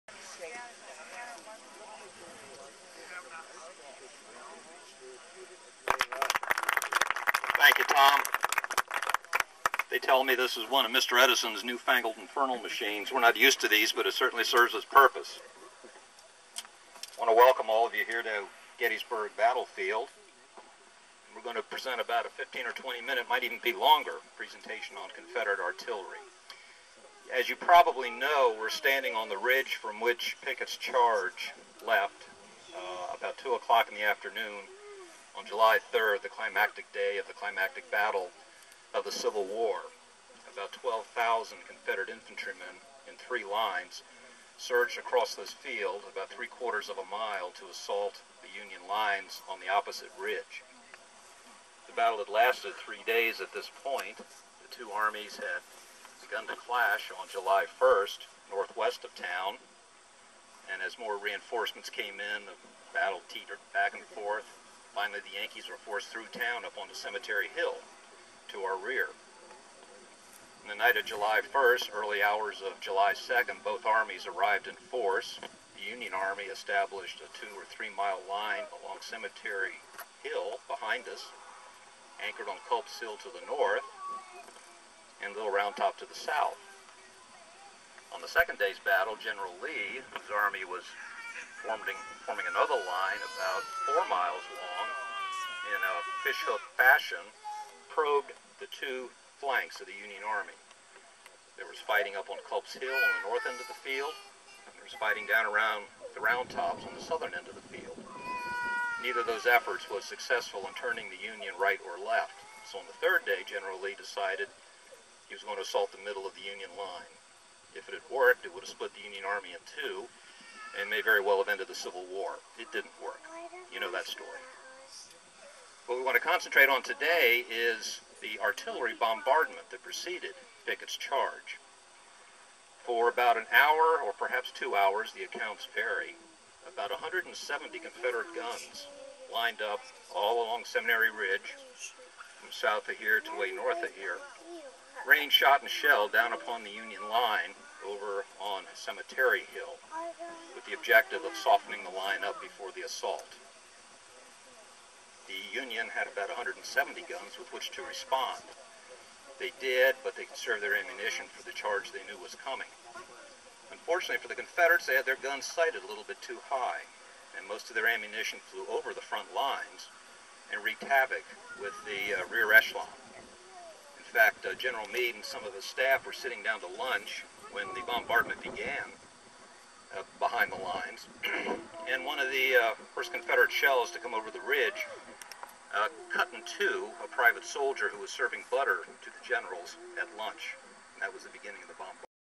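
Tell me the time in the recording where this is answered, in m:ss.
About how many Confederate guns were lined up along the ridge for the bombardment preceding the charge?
2:16.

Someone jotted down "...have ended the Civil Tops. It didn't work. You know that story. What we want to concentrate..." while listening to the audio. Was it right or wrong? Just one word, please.
wrong.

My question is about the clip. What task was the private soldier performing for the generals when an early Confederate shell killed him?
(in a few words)
serving butter.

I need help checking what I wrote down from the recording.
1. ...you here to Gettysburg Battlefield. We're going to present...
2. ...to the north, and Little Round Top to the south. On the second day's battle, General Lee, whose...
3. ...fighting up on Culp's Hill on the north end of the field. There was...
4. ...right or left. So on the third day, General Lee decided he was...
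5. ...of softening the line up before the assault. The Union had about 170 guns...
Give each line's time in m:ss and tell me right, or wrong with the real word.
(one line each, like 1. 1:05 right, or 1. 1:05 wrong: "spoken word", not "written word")
1. 0:17 right
2. 1:23 right
3. 1:41 right
4. 1:51 right
5. 2:31 right.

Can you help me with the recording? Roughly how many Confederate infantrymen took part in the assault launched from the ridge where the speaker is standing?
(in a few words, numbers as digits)
12,000.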